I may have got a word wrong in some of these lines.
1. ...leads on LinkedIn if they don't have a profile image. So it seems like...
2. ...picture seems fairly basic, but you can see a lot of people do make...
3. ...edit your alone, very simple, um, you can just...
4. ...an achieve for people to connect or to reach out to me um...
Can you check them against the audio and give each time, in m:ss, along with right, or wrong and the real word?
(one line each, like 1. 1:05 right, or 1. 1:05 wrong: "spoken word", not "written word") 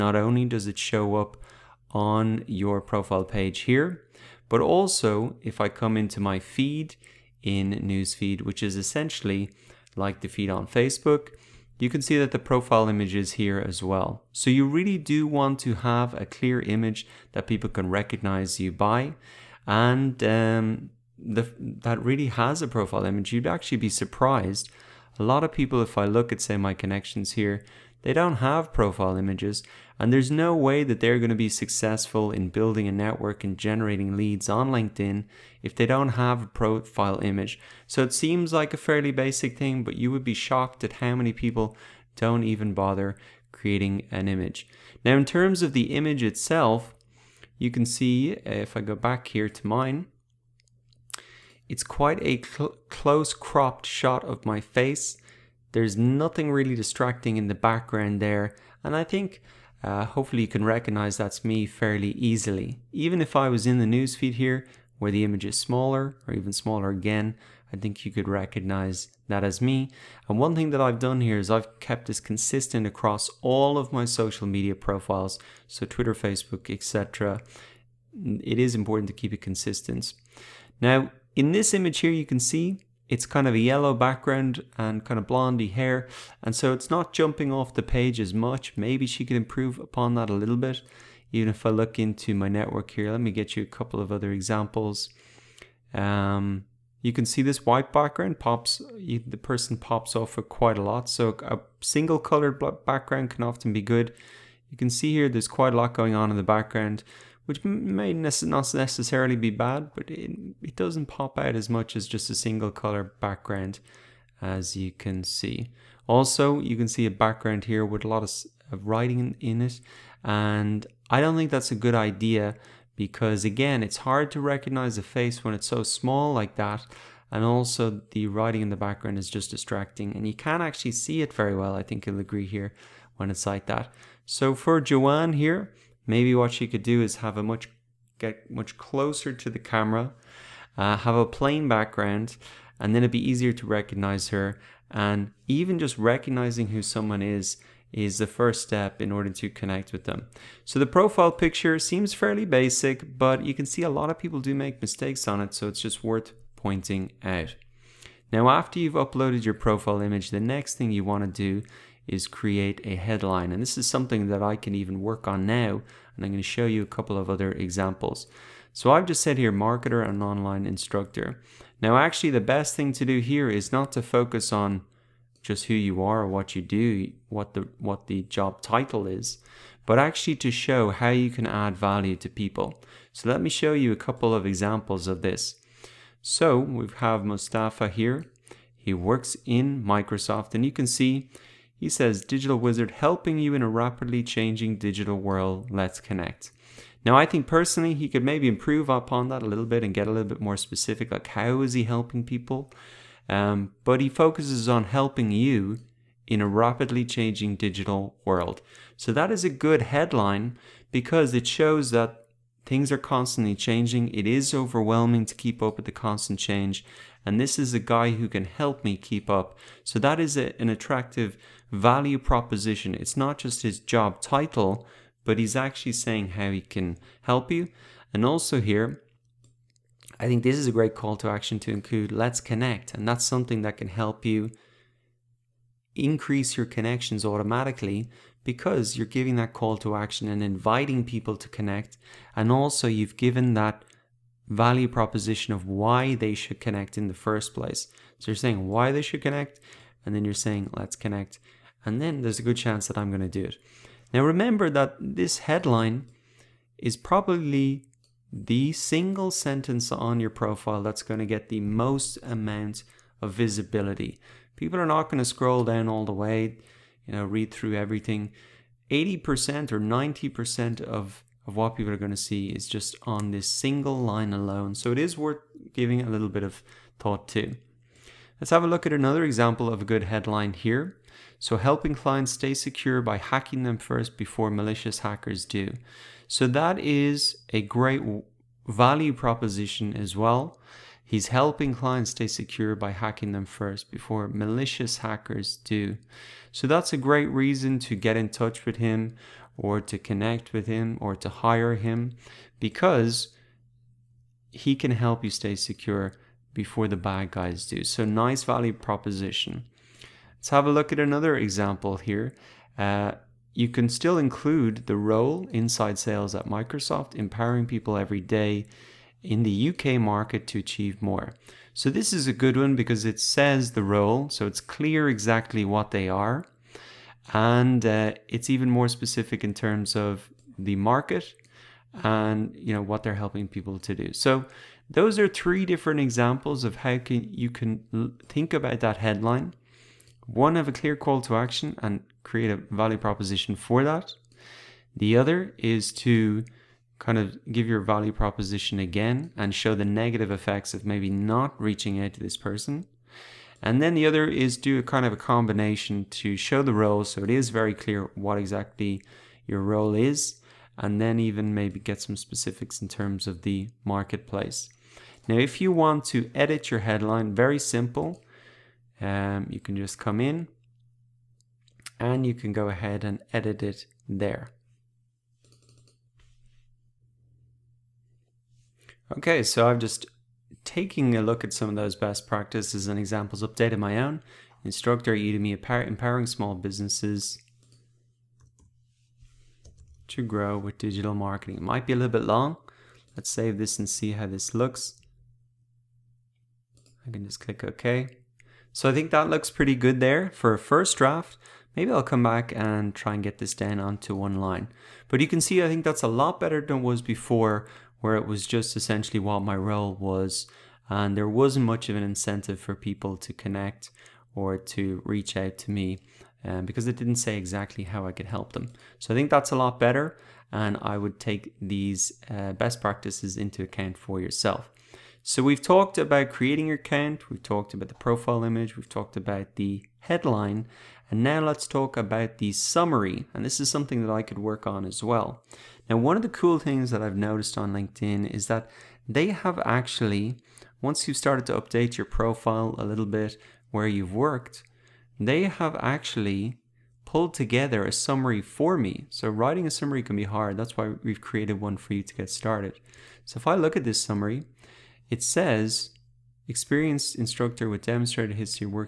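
1. 0:34 right
2. 2:31 right
3. 6:06 wrong: "headline", not "alone"
4. 6:51 wrong: "incentive", not "achieve".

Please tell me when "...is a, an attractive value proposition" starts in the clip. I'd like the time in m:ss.
3:40.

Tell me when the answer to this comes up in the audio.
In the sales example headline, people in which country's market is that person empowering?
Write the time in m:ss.
5:19.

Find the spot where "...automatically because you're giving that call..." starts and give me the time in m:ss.
3:57.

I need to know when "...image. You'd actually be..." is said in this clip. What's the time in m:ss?
0:23.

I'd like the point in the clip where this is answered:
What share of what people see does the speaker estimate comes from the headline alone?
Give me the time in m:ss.
4:28.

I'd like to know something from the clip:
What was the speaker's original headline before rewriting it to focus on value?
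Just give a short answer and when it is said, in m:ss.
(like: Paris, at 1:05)
Marketer and online instructor, at 2:49.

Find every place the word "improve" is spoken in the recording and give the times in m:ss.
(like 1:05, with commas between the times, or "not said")
1:29, 3:18.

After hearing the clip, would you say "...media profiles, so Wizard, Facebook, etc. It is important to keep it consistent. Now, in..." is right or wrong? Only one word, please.
wrong.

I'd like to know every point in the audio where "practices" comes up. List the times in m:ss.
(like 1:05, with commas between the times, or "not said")
6:22, 7:02.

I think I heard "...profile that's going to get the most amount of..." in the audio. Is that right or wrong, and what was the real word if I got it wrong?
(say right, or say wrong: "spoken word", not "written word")
right.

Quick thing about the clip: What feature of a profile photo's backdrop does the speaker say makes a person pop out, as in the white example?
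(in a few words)
Single colored background.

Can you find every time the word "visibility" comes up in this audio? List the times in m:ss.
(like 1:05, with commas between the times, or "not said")
4:23.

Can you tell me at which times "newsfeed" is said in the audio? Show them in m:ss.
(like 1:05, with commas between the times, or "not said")
0:07, 1:03.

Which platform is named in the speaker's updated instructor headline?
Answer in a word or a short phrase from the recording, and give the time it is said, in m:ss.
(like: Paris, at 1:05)
Udemy, at 6:25.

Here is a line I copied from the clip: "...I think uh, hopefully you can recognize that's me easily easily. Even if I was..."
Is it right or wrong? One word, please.
wrong.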